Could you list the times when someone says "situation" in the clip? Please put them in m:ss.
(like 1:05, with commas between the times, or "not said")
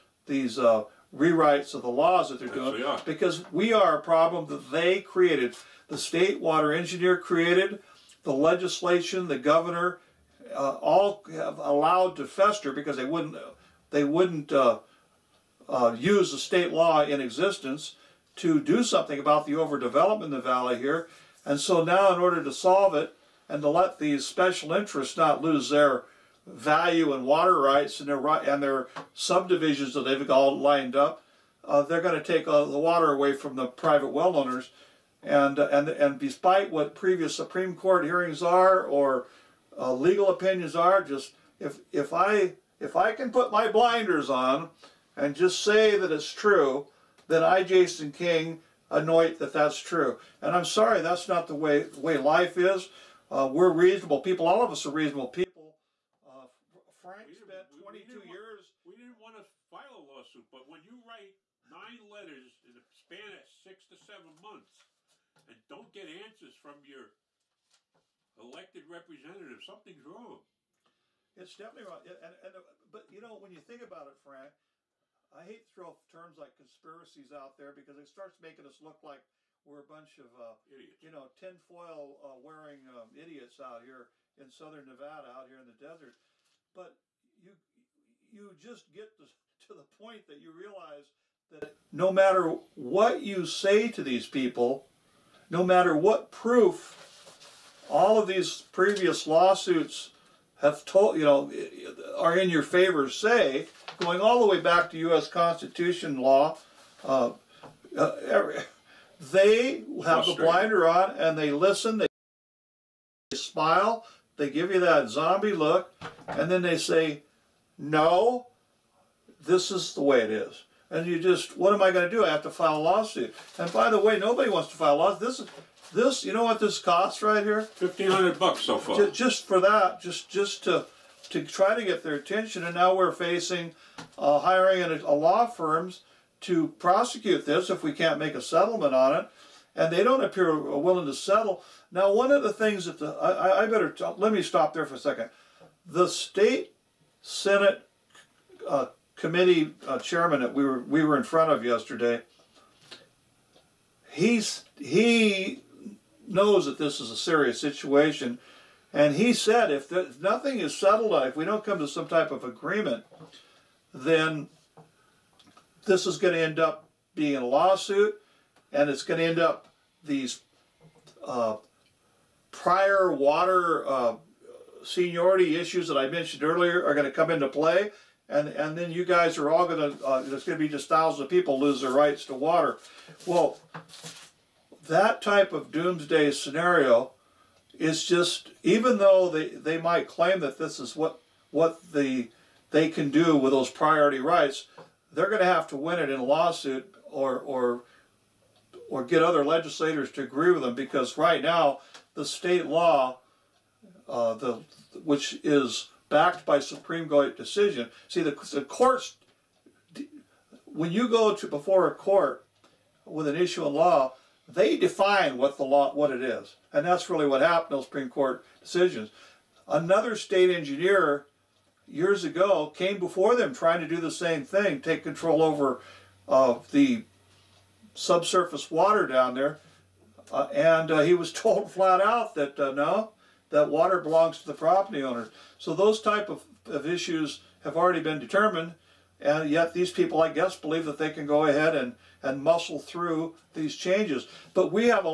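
2:37.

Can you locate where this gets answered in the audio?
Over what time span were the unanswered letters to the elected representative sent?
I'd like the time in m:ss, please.
1:03.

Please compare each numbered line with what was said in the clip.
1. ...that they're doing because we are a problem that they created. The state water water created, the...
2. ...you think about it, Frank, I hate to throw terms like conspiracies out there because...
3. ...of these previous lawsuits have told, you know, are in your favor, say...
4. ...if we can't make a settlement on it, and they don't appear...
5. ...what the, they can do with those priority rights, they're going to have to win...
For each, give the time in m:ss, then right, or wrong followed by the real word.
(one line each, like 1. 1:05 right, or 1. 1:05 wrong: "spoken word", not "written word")
1. 0:02 wrong: "engineer", not "water"
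2. 1:13 right
3. 1:38 right
4. 2:17 right
5. 3:11 right.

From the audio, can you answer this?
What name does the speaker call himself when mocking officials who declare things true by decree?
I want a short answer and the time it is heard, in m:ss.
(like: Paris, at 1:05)
Jason King, at 0:47.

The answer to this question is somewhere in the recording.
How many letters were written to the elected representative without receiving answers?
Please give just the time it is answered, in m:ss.
1:01.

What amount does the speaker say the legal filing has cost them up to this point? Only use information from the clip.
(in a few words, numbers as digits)
$1,500.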